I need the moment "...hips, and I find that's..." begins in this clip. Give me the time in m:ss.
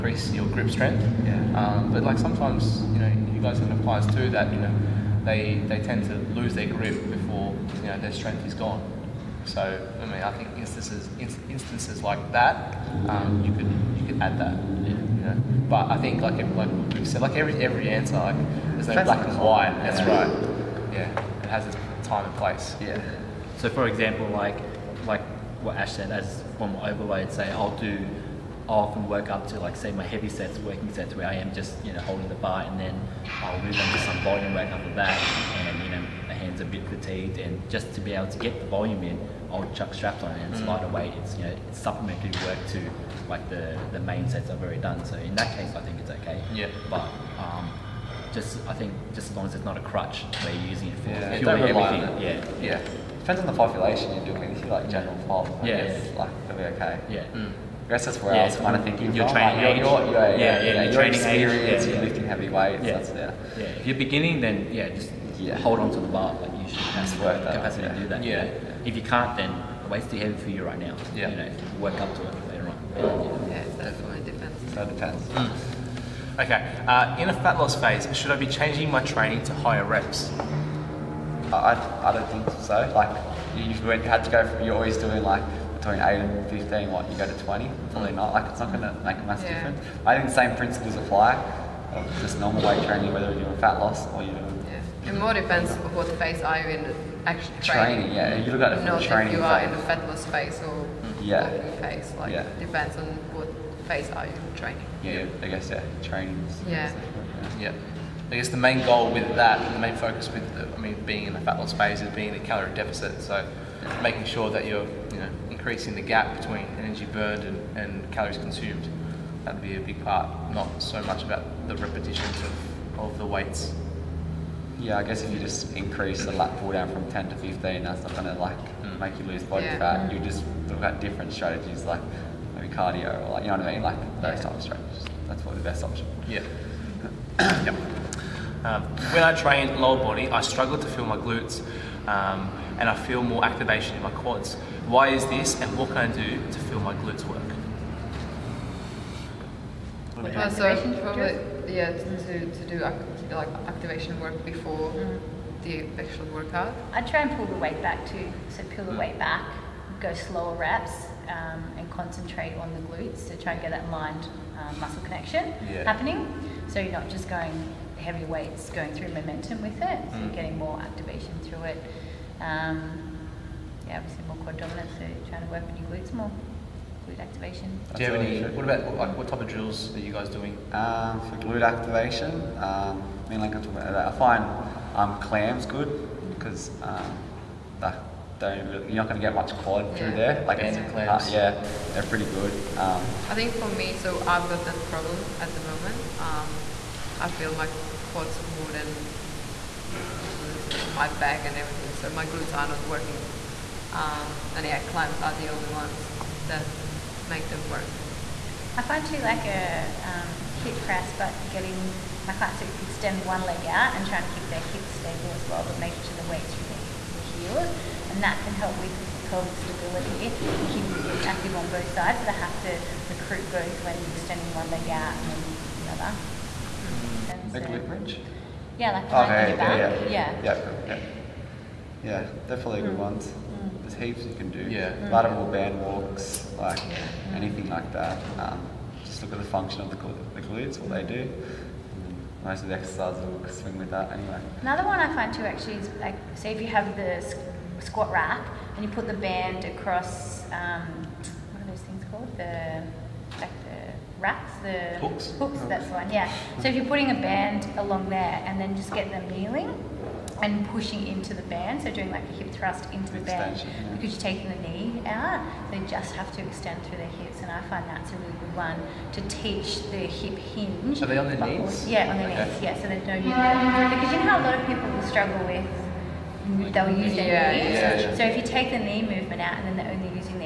4:27.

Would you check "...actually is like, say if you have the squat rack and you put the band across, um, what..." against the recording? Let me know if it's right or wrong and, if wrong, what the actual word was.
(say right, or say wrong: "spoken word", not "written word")
right.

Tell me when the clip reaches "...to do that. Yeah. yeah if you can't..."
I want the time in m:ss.
1:07.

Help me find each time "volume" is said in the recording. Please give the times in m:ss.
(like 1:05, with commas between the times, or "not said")
0:34, 0:38.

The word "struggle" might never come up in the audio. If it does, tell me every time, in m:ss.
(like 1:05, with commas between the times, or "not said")
2:20, 4:35.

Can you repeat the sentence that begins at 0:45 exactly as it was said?
So in that case, I think it's okay.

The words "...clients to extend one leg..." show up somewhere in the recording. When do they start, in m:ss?
3:32.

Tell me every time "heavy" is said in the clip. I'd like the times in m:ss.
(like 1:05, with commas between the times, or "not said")
0:30, 1:02, 1:10, 2:47.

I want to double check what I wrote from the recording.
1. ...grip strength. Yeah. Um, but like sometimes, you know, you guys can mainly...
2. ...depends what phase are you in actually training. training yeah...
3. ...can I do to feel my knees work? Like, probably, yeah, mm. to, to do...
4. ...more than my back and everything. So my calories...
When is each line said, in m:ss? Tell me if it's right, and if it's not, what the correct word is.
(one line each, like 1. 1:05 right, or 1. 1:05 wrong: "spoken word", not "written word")
1. 0:00 wrong: "apply", not "mainly"
2. 1:35 right
3. 2:25 wrong: "glutes", not "knees"
4. 3:18 wrong: "glutes", not "calories".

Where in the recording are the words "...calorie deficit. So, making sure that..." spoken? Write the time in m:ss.
1:52.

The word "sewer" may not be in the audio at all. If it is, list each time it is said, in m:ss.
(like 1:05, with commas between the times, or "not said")
not said.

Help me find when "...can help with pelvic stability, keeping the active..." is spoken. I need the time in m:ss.
3:38.